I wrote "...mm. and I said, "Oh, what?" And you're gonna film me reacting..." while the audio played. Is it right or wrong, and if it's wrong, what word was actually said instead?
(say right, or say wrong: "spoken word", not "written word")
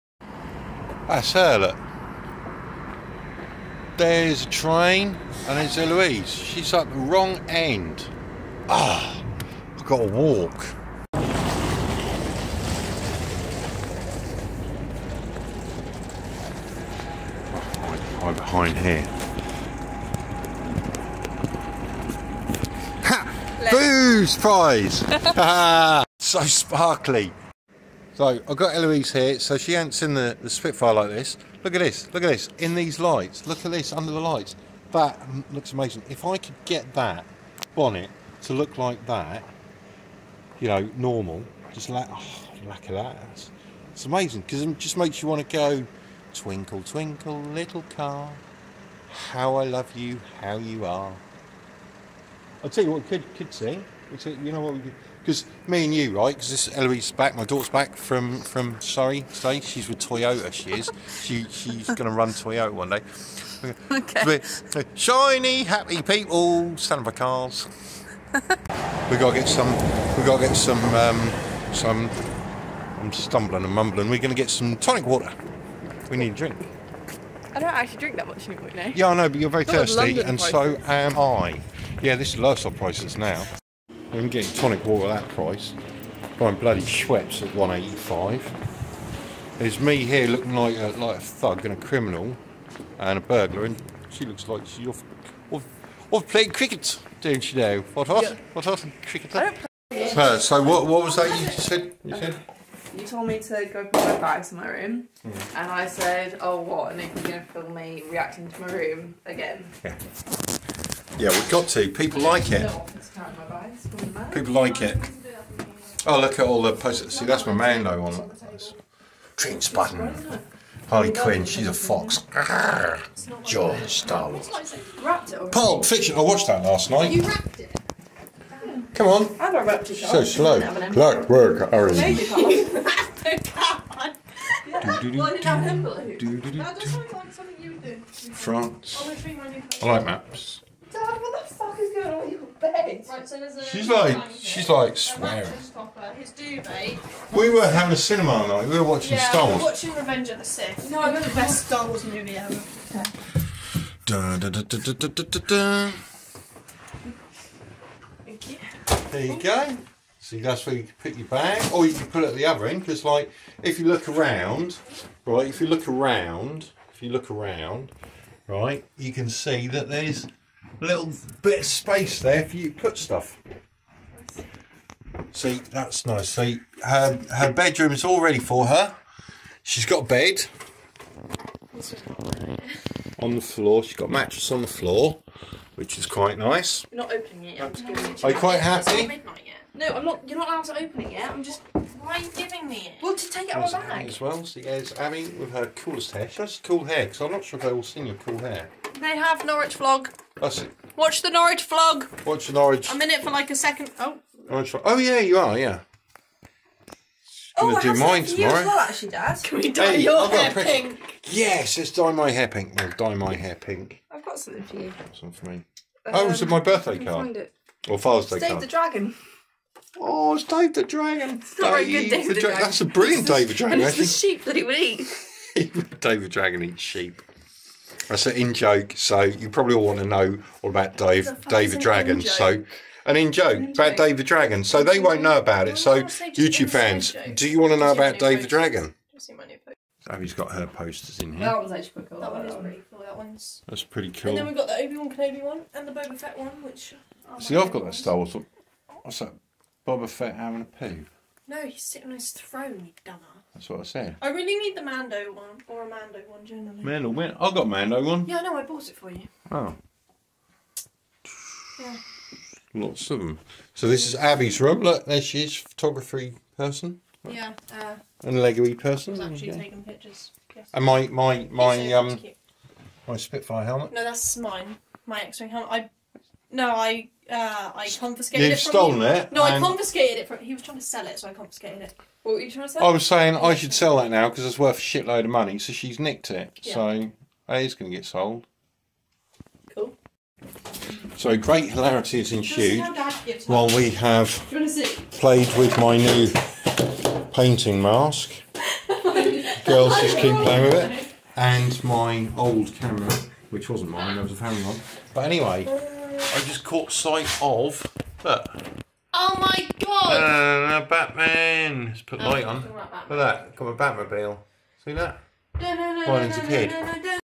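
right.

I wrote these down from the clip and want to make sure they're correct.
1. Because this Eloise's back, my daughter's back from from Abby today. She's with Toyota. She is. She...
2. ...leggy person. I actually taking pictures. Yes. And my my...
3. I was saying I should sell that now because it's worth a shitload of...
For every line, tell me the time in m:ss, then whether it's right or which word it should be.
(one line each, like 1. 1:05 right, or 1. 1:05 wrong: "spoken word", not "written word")
1. 0:56 wrong: "Surrey", not "Abby"
2. 4:28 right
3. 4:42 right.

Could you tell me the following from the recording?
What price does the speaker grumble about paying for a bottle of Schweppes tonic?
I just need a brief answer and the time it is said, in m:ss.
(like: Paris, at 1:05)
185, at 1:27.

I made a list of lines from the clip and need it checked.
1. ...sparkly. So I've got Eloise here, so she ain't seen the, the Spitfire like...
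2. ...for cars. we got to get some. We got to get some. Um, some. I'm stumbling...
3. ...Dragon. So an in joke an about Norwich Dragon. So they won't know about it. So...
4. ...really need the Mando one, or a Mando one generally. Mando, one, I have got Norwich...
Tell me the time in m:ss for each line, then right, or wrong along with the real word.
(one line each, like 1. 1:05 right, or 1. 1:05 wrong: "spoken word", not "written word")
1. 0:26 right
2. 1:06 right
3. 3:51 wrong: "David", not "Norwich"
4. 4:14 wrong: "Mando", not "Norwich".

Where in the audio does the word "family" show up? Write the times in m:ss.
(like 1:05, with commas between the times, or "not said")
5:04.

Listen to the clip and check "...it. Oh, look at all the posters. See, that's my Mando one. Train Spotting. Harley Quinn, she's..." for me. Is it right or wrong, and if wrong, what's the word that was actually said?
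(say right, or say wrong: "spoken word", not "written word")
right.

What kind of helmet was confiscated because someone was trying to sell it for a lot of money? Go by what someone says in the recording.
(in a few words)
X-wing helmet.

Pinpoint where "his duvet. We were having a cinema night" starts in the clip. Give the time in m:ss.
2:26.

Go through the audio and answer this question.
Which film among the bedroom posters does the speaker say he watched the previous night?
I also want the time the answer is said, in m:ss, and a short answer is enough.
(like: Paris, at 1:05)
Pulp Fiction, at 2:05.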